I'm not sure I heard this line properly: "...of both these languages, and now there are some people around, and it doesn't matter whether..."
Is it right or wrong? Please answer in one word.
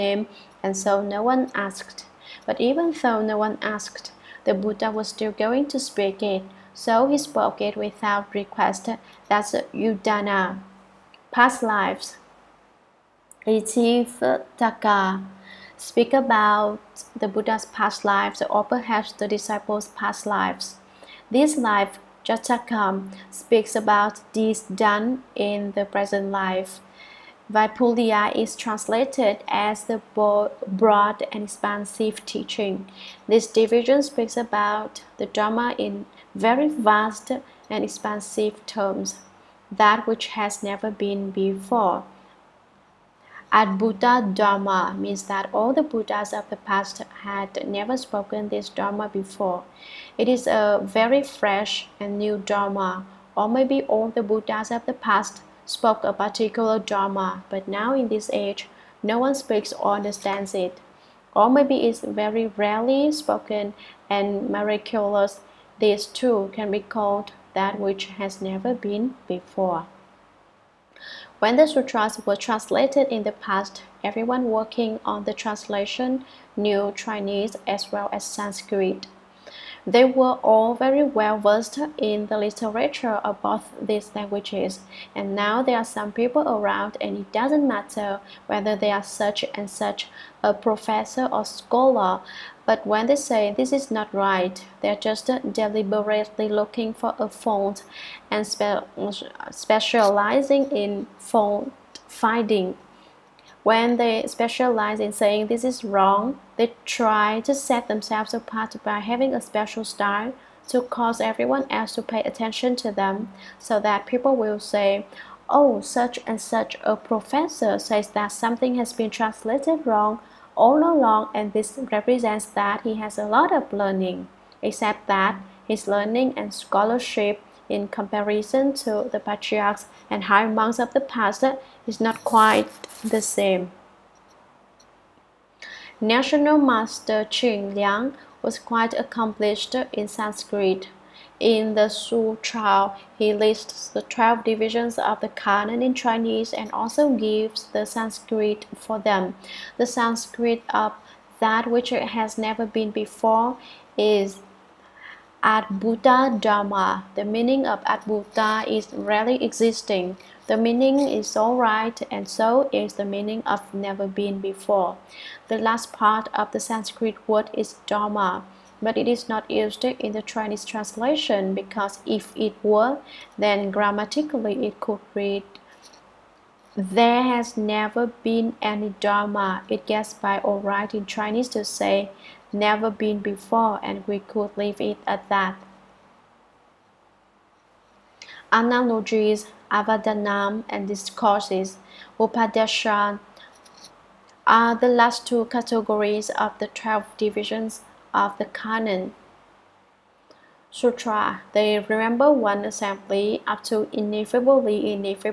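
right.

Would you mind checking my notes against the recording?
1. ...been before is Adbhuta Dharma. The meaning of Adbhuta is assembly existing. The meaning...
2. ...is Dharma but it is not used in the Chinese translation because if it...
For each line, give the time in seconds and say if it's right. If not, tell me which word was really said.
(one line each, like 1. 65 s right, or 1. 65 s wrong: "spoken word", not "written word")
1. 152 s wrong: "rarely", not "assembly"
2. 167 s right.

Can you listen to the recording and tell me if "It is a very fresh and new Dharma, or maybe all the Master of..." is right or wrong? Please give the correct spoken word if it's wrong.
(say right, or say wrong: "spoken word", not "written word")
wrong: "Buddhas", not "Master".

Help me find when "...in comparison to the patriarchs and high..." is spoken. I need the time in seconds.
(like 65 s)
127 s.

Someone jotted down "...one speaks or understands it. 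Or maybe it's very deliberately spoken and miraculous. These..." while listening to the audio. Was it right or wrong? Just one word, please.
wrong.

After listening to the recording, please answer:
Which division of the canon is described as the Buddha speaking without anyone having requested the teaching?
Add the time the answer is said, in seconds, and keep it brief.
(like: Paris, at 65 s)
Udana, at 9 s.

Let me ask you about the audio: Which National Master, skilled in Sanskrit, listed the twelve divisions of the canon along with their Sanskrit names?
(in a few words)
Ching Liang.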